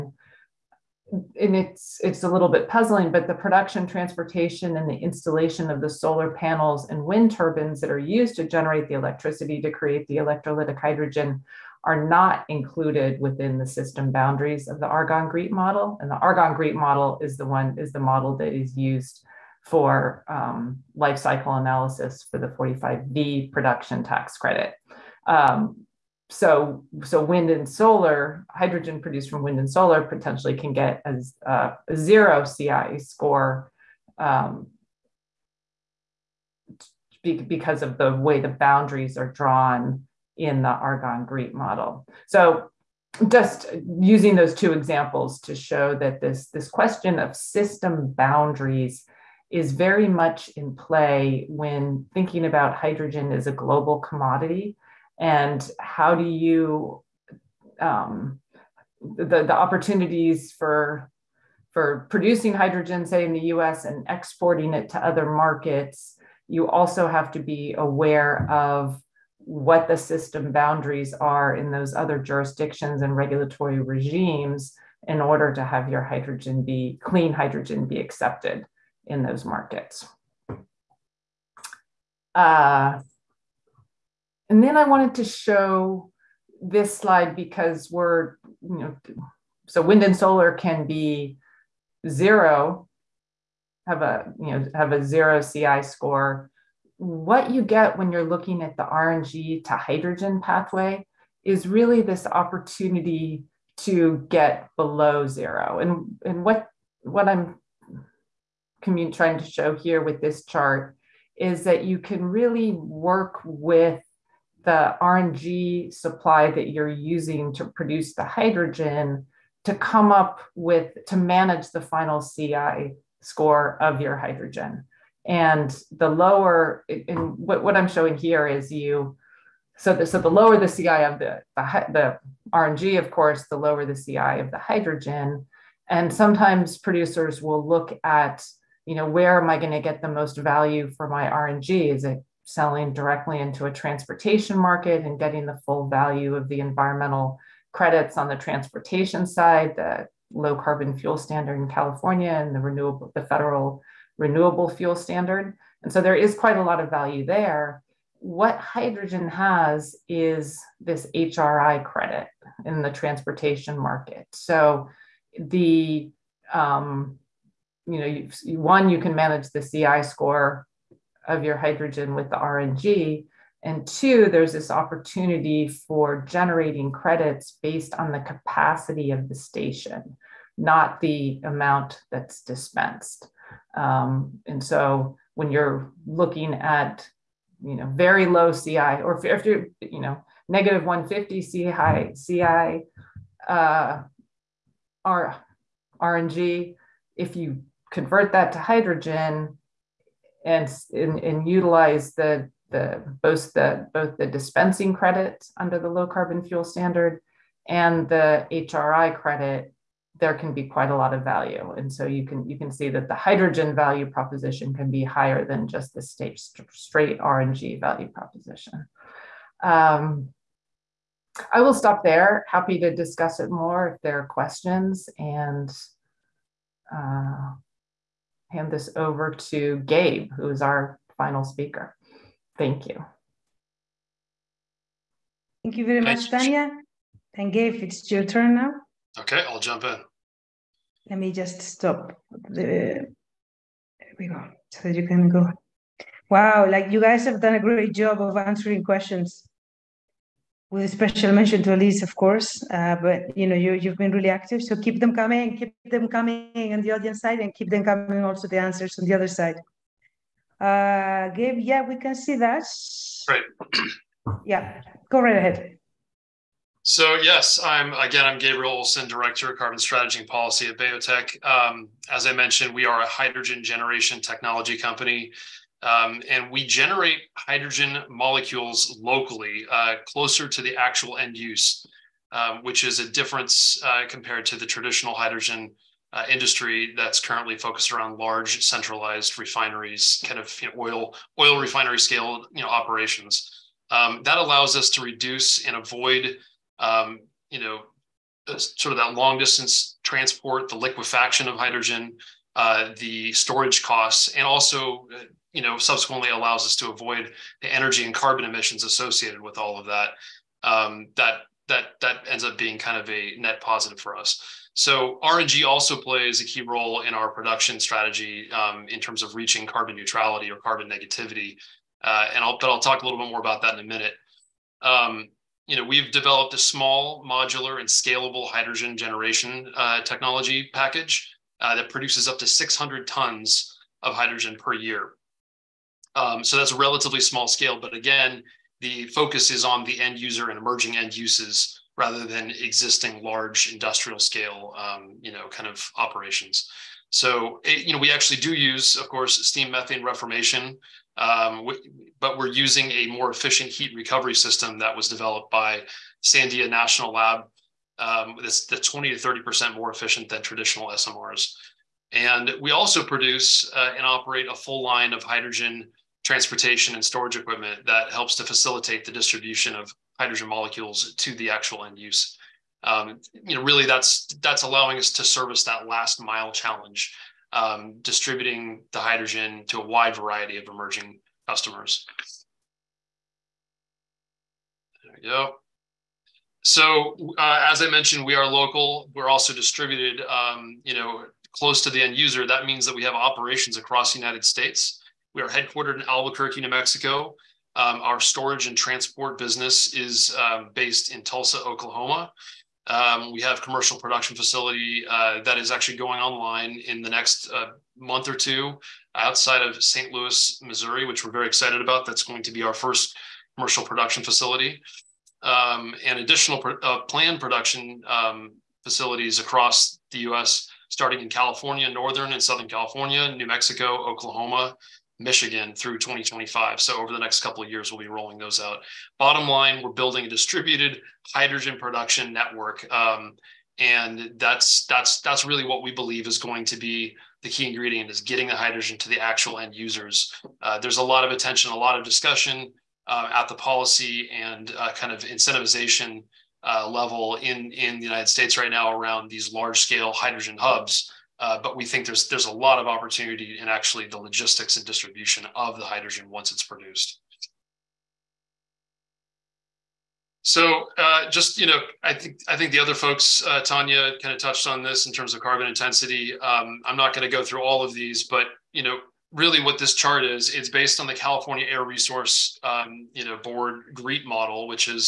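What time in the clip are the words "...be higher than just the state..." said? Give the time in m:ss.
3:34.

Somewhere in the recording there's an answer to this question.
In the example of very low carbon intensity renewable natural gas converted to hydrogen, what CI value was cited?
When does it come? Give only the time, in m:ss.
3:10.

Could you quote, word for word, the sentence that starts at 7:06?
So over the next couple of years, we'll be rolling those out.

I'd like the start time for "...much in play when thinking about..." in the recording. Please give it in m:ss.
0:50.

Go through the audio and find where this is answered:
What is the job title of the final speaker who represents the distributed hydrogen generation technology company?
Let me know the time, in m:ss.
4:29.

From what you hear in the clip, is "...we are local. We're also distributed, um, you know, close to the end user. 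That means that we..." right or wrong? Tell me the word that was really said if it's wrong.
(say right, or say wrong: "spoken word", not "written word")
right.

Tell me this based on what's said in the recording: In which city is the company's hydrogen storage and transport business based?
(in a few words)
Tulsa, Oklahoma.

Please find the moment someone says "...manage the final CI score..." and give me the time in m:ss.
2:01.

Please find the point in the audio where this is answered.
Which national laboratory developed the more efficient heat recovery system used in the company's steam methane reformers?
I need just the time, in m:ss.
5:56.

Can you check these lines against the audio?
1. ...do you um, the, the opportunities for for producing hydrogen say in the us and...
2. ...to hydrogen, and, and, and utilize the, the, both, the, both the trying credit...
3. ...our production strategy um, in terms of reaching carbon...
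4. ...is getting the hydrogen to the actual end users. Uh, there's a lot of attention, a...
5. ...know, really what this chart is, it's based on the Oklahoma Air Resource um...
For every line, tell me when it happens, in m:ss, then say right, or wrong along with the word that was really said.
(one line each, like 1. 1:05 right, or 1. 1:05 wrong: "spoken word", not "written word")
1. 0:56 right
2. 3:18 wrong: "dispensing", not "trying"
3. 5:17 right
4. 7:18 right
5. 7:48 wrong: "California", not "Oklahoma".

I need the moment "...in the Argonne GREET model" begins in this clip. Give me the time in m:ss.
0:40.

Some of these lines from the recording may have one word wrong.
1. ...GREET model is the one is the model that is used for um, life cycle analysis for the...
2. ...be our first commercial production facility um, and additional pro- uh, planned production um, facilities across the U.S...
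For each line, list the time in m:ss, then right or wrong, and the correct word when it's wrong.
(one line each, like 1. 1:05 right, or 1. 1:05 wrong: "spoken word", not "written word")
1. 0:16 right
2. 6:52 right.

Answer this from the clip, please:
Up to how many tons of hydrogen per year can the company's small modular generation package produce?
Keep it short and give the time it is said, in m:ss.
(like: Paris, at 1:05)
600, at 5:32.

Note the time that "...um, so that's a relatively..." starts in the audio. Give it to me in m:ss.
5:36.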